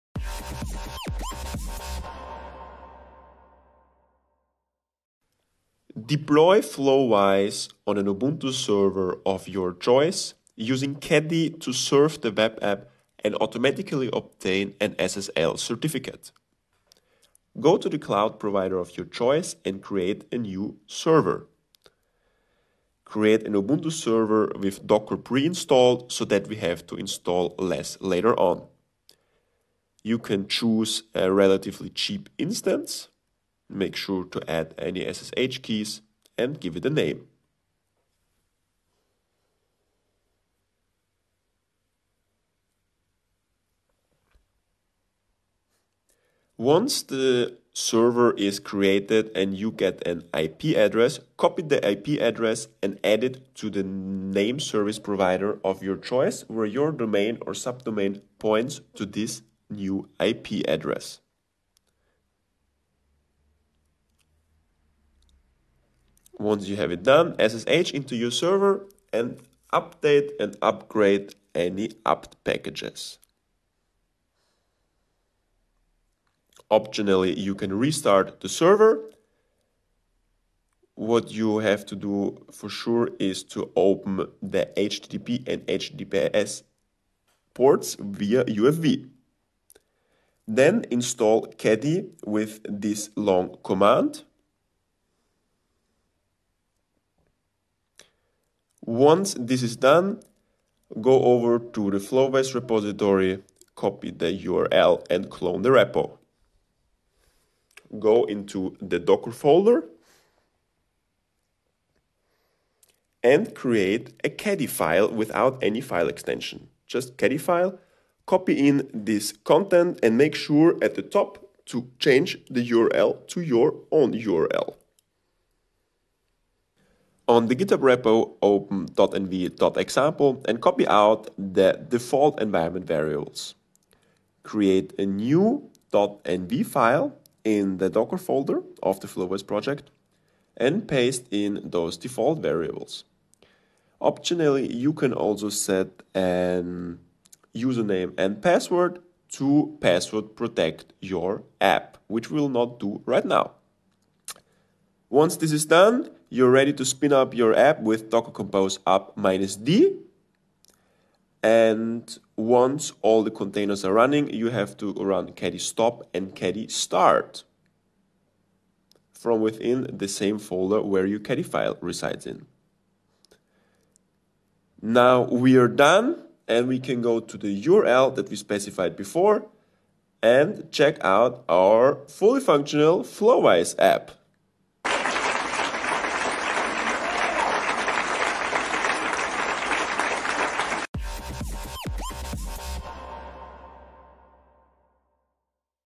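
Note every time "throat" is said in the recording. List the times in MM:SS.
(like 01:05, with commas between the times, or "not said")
not said.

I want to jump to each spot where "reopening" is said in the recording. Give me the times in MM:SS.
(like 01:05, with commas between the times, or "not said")
not said.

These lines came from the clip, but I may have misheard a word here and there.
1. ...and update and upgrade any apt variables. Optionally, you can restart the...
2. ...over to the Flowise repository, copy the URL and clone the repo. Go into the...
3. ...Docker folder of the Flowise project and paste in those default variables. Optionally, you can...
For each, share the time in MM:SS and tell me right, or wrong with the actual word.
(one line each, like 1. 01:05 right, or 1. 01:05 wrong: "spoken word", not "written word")
1. 01:09 wrong: "packages", not "variables"
2. 01:41 right
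3. 02:17 right.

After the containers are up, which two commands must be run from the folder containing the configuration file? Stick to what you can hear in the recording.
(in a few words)
caddy stop and caddy start.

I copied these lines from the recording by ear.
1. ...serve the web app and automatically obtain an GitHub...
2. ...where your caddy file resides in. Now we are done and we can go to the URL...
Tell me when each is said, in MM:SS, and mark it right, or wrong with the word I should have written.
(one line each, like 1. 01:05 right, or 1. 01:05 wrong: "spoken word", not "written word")
1. 00:11 wrong: "SSL", not "GitHub"
2. 02:50 right.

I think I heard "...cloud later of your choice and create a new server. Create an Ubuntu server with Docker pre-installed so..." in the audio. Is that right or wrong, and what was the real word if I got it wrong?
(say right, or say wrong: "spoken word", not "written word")
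wrong: "provider", not "later".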